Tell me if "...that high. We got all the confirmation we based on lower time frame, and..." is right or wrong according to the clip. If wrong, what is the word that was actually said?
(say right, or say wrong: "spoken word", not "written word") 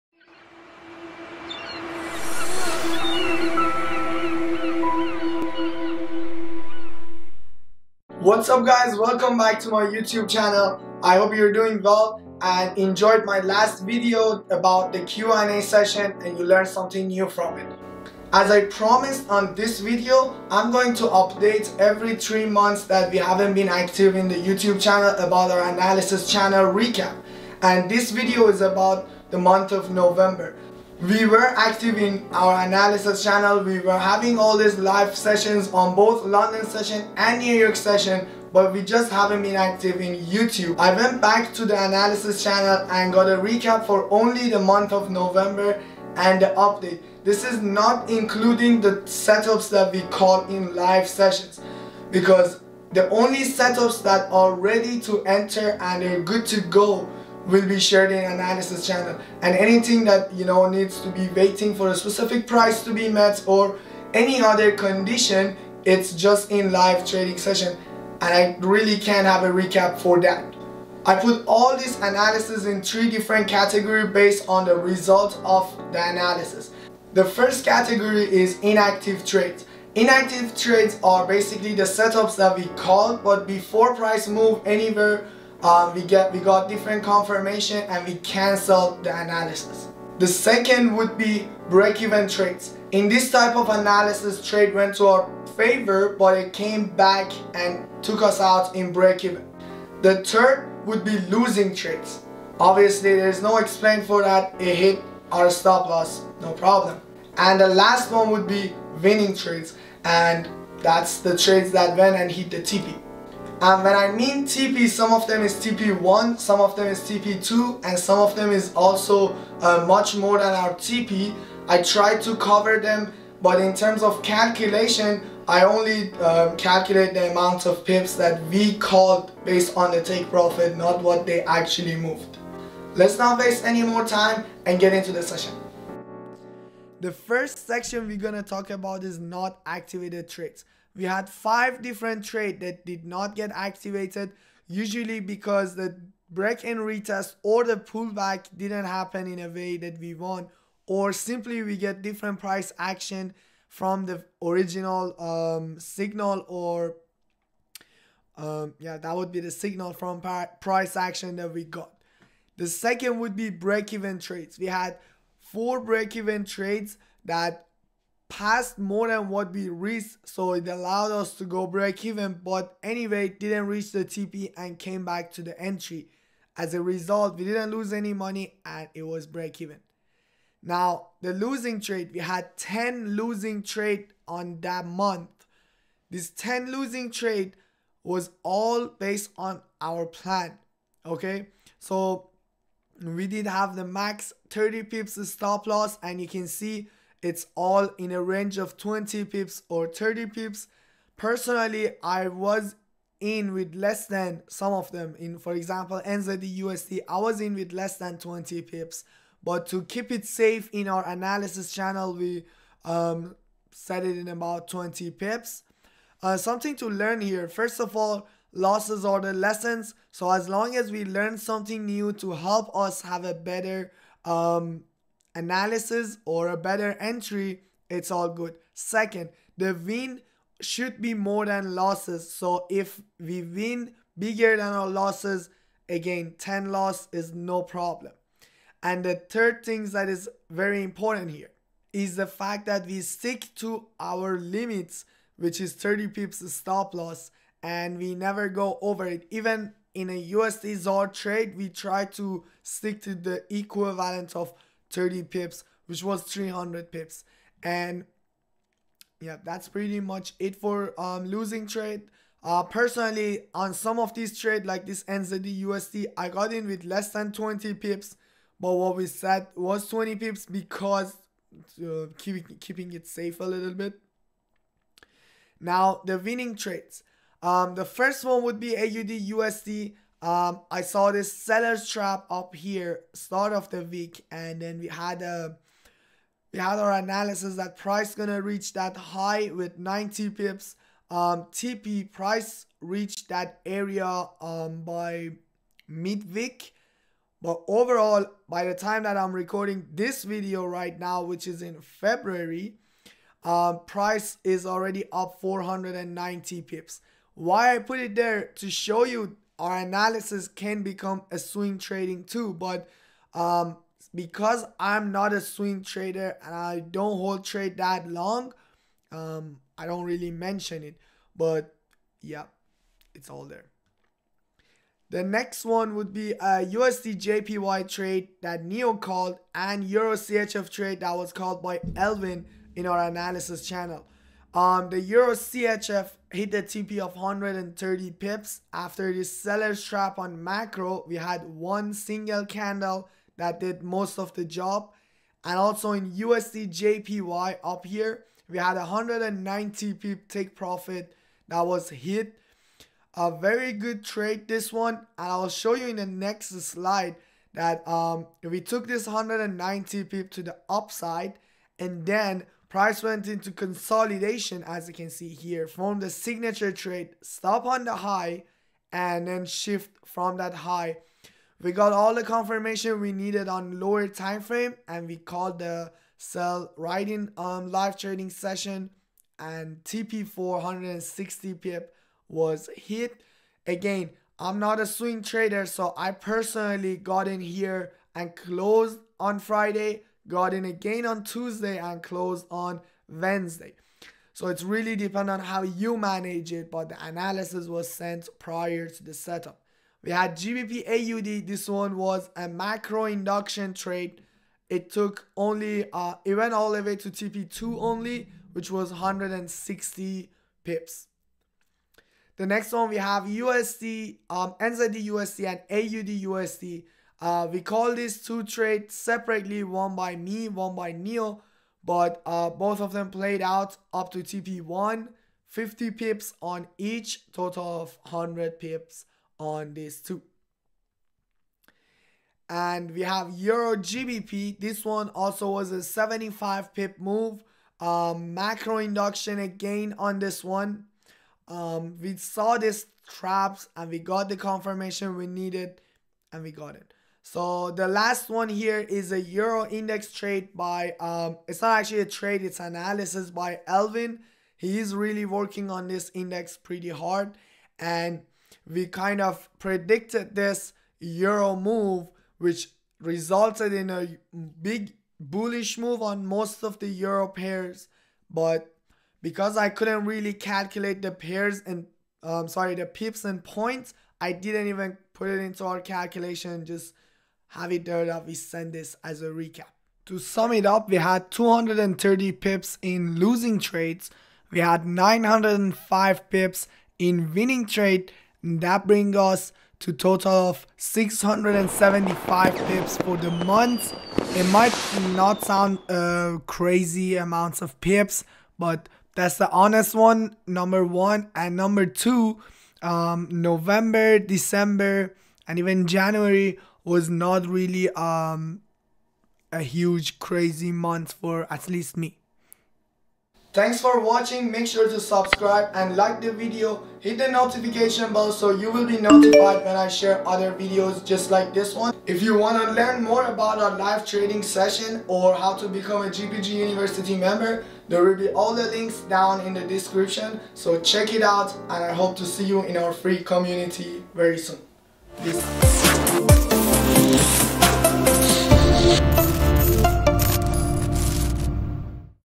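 wrong: "needed", not "based".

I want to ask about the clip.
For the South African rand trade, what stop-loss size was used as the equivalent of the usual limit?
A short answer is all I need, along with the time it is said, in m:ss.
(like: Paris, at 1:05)
300 pips, at 4:16.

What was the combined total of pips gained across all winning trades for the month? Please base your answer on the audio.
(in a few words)
905 pips.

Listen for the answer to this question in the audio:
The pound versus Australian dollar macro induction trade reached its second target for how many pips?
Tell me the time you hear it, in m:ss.
6:48.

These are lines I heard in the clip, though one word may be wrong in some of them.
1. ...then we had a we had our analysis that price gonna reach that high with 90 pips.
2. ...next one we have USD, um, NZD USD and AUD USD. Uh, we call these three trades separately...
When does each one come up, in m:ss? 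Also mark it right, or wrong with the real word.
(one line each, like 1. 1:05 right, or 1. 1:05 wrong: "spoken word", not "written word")
1. 4:44 right
2. 6:52 wrong: "two", not "three".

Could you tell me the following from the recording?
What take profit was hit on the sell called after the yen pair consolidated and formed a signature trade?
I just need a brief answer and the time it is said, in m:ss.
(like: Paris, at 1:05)
460 pips, at 6:20.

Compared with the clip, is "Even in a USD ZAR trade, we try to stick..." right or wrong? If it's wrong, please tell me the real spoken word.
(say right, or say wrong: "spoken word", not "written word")
right.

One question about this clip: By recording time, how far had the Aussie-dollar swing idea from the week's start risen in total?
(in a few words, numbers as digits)
490 pips.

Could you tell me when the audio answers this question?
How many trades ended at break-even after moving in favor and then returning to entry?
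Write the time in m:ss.
2:45.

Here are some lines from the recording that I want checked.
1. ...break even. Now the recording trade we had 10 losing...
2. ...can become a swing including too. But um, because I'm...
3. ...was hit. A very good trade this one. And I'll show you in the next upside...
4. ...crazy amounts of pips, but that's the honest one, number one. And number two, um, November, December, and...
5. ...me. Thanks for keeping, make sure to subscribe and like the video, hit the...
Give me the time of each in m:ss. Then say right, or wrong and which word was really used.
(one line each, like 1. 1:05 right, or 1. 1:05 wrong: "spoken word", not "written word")
1. 2:59 wrong: "losing", not "recording"
2. 5:10 wrong: "trading", not "including"
3. 5:51 wrong: "slide", not "upside"
4. 8:16 right
5. 8:31 wrong: "watching", not "keeping".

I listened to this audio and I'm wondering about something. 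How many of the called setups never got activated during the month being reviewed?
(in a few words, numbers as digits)
5.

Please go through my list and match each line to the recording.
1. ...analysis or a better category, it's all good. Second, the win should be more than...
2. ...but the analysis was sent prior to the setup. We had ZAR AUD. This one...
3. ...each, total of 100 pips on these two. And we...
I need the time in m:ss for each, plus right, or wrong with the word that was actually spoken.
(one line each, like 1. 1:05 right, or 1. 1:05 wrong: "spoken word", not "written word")
1. 3:45 wrong: "entry", not "category"
2. 6:36 wrong: "GBP", not "ZAR"
3. 7:06 right.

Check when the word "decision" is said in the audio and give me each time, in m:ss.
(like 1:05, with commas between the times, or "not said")
not said.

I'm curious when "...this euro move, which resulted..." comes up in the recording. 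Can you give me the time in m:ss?
7:40.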